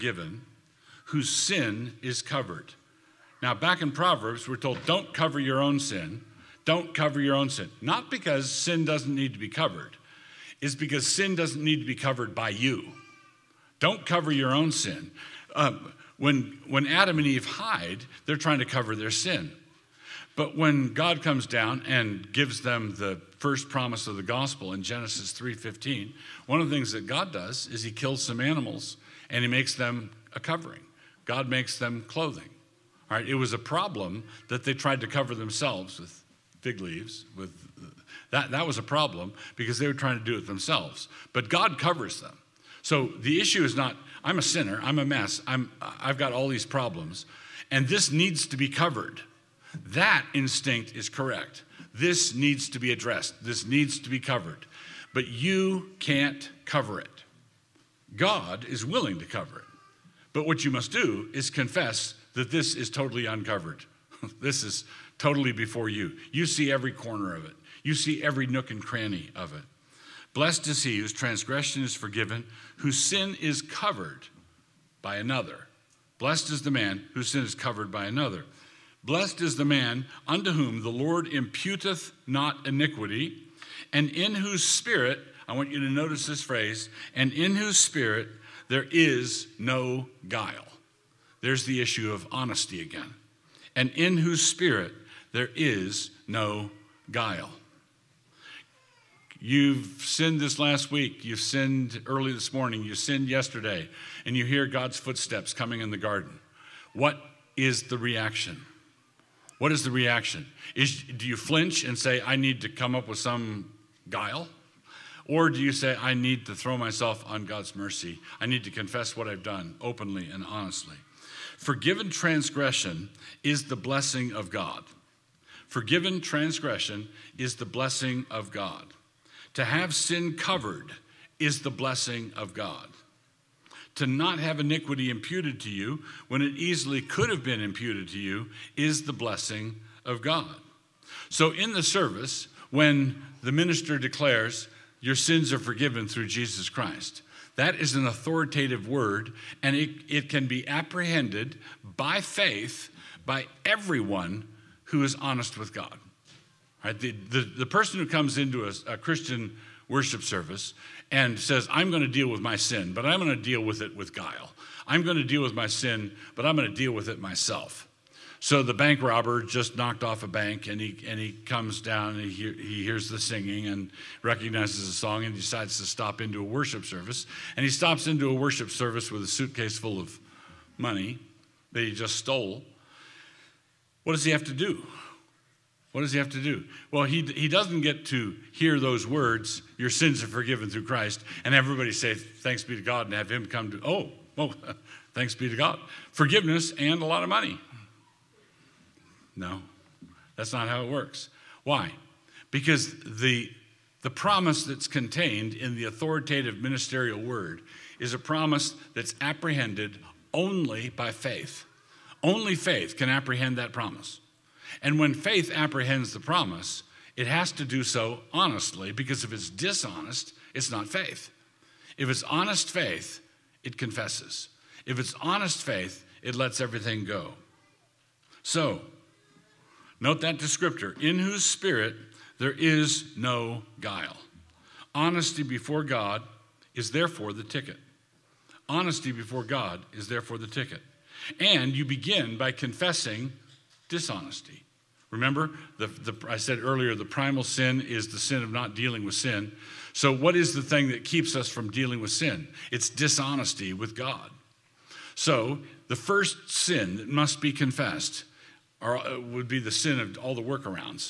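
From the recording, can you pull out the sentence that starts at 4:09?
So, what is the thing that keeps us from dealing with sin?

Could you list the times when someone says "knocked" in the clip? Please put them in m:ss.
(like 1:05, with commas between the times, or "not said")
2:49.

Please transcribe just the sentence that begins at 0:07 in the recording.
Not because sin doesn't need to be covered, it's because sin doesn't need to be covered by you.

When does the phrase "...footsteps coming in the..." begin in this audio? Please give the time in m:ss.
1:44.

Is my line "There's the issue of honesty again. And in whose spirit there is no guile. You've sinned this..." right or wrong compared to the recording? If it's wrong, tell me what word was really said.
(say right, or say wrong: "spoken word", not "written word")
right.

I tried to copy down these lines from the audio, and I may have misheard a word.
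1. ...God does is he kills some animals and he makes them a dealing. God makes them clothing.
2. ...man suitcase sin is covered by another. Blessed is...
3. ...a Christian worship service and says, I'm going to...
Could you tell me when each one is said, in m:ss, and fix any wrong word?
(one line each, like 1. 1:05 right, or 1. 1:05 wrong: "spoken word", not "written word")
1. 0:27 wrong: "covering", not "dealing"
2. 1:16 wrong: "whose", not "suitcase"
3. 2:38 right.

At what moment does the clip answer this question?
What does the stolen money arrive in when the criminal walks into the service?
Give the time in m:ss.
2:59.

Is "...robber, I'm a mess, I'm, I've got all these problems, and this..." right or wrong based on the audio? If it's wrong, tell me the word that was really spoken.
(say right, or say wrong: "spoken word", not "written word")
wrong: "sinner", not "robber".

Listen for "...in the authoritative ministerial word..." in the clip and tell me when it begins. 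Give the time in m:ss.
3:25.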